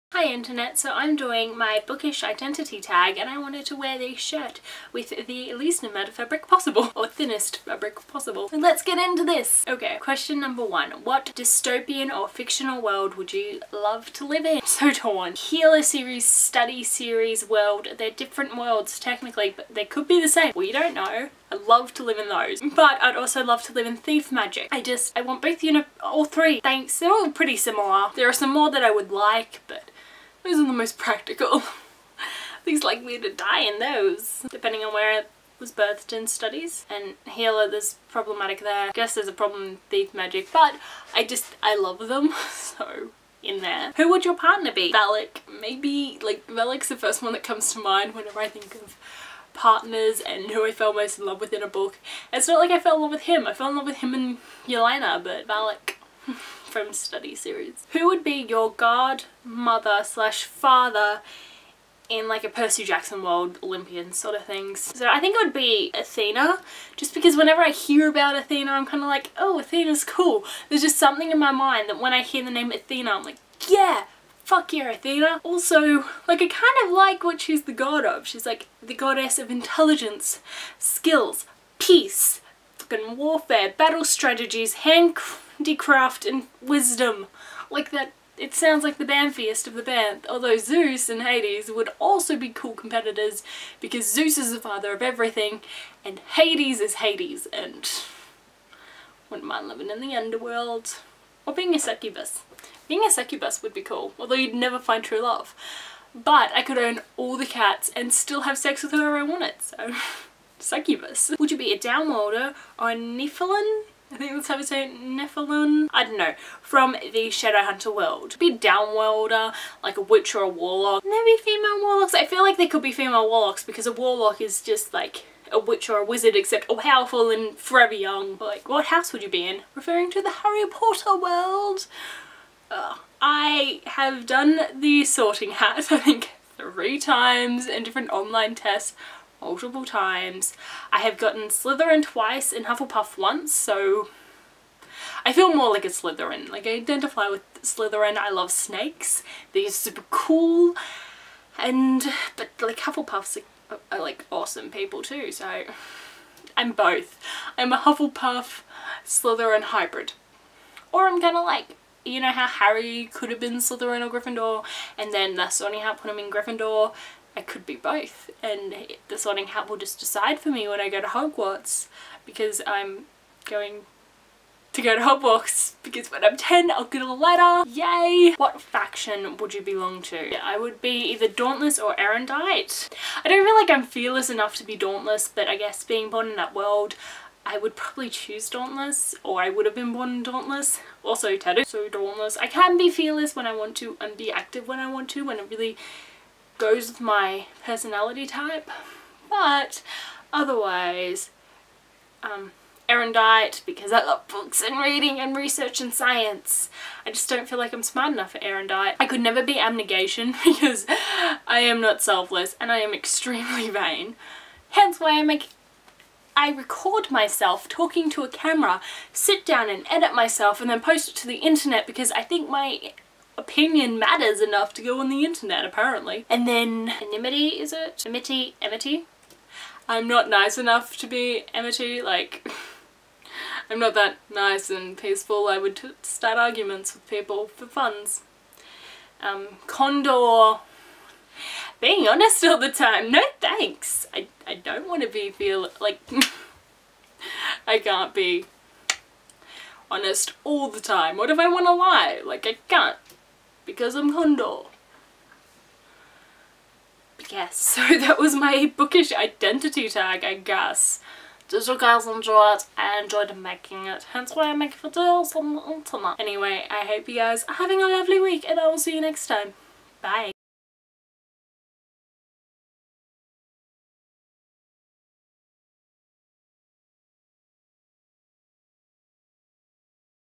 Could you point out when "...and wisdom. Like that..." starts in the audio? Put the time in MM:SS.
01:26.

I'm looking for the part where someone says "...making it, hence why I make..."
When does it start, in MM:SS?
04:23.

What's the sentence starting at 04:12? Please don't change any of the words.
Like I can't because I'm Candor.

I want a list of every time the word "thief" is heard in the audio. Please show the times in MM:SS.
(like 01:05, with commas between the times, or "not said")
00:23, 00:39.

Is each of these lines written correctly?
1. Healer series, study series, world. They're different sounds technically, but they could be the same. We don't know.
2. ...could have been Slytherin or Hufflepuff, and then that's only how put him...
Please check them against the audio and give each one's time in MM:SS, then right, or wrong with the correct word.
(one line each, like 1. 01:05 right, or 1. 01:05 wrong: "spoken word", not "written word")
1. 00:15 wrong: "worlds", not "sounds"
2. 02:43 wrong: "Gryffindor", not "Hufflepuff".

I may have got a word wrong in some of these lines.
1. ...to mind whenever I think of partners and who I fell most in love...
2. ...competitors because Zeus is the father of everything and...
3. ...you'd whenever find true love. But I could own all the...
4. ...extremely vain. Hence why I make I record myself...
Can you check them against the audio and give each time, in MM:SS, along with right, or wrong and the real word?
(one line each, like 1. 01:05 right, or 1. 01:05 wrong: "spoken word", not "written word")
1. 00:47 right
2. 01:32 right
3. 01:44 wrong: "never", not "whenever"
4. 03:32 right.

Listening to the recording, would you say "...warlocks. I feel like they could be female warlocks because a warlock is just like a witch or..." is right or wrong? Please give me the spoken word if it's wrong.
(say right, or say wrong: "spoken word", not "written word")
right.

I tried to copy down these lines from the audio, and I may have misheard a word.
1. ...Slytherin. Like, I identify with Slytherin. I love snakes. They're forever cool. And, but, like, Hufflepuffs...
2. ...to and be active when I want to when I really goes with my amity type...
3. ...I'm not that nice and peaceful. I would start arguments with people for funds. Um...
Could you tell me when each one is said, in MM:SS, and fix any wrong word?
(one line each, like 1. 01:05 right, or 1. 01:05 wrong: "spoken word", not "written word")
1. 02:25 wrong: "super", not "forever"
2. 03:13 wrong: "personality", not "amity"
3. 03:53 right.